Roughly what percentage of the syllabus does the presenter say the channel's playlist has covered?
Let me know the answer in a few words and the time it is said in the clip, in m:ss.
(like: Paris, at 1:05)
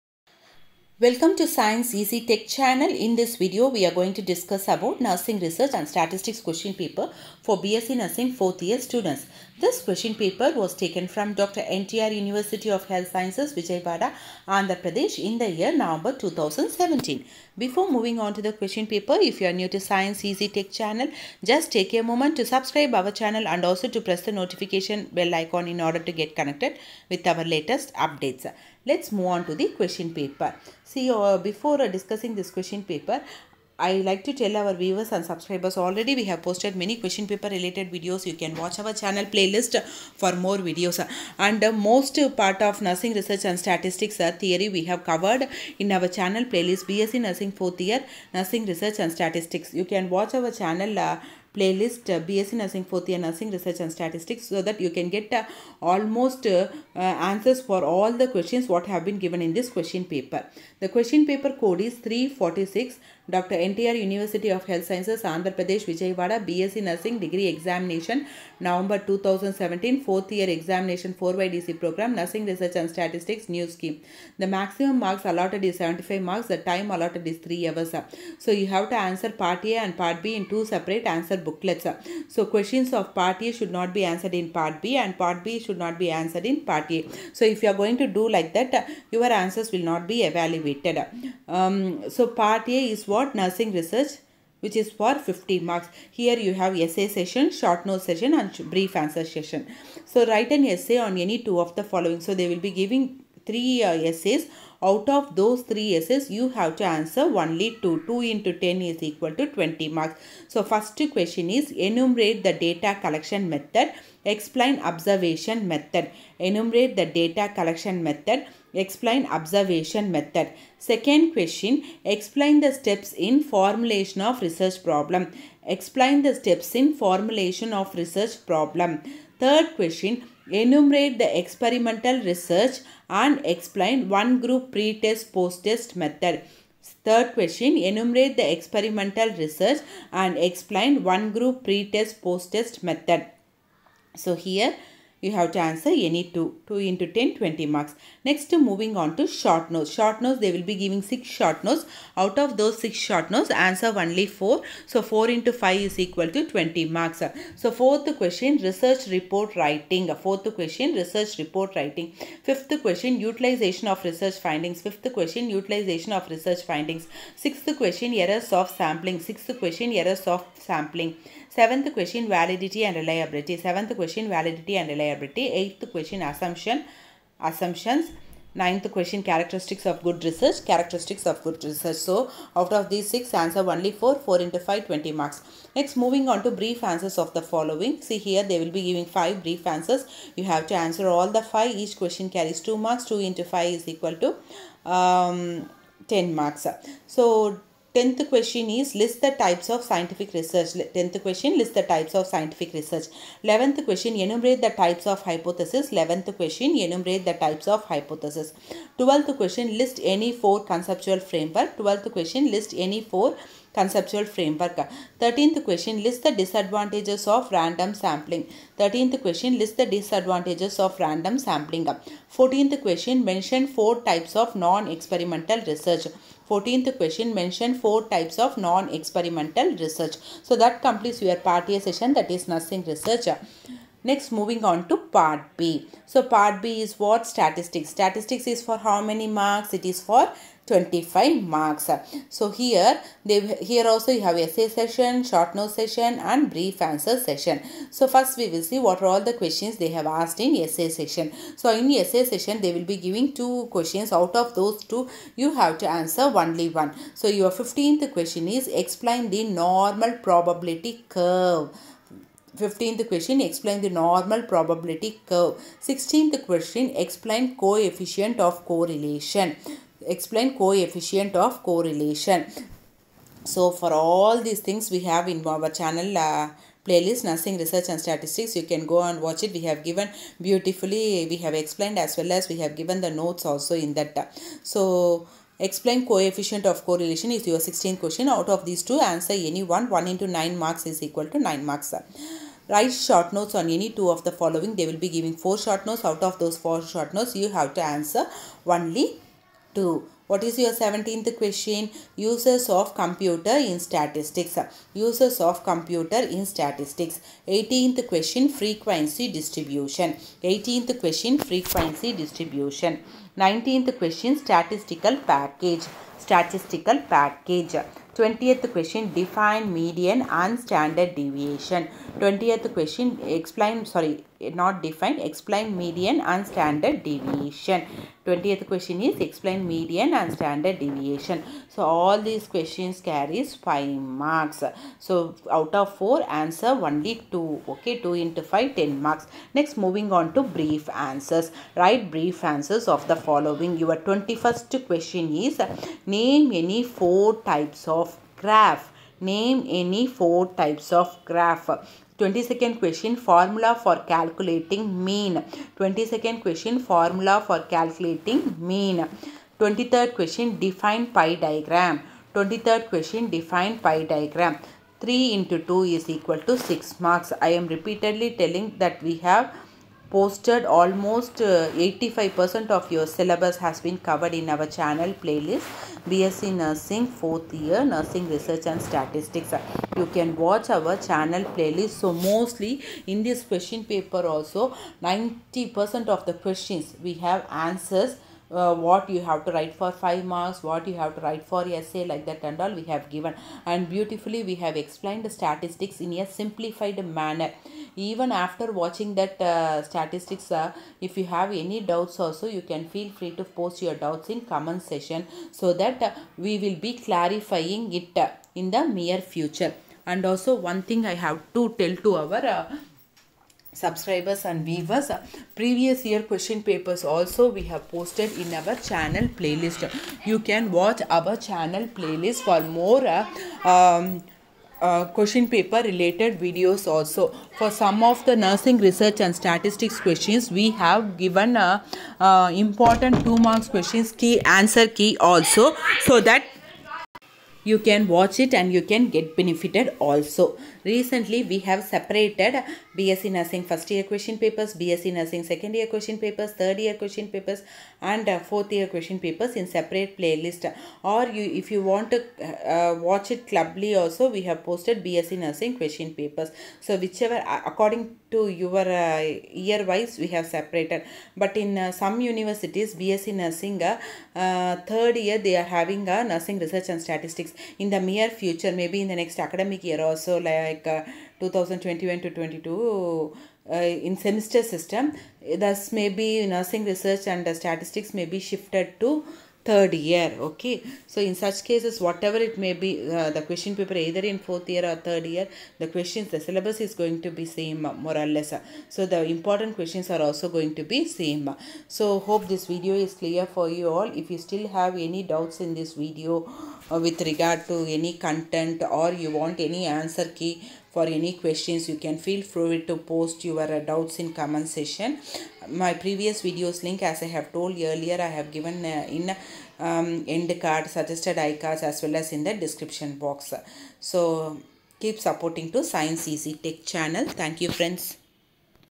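85%, at 6:11.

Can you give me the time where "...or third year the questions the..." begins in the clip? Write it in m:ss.
8:04.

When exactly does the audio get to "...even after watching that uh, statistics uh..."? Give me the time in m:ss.
6:37.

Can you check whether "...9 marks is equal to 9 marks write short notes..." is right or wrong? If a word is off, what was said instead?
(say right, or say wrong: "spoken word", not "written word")
right.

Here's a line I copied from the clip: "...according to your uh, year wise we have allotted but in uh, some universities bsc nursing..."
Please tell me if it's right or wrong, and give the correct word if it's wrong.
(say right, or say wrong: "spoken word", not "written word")
wrong: "separated", not "allotted".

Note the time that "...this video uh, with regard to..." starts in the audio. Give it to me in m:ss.
8:15.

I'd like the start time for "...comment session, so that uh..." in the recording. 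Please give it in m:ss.
6:44.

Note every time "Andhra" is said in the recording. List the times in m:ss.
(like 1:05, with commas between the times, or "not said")
0:14, 1:05.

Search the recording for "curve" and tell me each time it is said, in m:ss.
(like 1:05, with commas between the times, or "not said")
4:21, 4:25.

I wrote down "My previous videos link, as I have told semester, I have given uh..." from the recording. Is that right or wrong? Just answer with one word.
wrong.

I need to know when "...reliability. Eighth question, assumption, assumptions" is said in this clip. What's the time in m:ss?
2:54.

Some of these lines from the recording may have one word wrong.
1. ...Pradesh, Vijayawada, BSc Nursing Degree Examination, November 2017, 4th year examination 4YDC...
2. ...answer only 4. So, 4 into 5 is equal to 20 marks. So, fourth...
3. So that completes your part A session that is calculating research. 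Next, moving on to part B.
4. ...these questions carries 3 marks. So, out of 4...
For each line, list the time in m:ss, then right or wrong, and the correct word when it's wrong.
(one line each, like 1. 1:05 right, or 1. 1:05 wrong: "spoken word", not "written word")
1. 1:05 right
2. 2:33 right
3. 3:50 wrong: "nursing", not "calculating"
4. 5:32 wrong: "5", not "3".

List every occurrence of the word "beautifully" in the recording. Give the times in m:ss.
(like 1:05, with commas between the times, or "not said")
4:40, 6:33.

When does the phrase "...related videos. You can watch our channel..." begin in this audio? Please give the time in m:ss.
0:37.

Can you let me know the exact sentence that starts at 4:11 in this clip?
So in essay session they will be giving two questions out of those two you have to answer only one.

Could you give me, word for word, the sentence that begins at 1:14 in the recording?
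The maximum marks allotted is 75 marks, the time allotted is 3 hours.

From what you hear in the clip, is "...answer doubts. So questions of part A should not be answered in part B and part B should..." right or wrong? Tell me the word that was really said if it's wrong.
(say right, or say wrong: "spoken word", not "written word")
wrong: "booklets", not "doubts".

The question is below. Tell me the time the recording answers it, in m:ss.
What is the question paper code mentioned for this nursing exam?
1:01.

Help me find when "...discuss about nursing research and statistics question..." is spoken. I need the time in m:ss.
0:04.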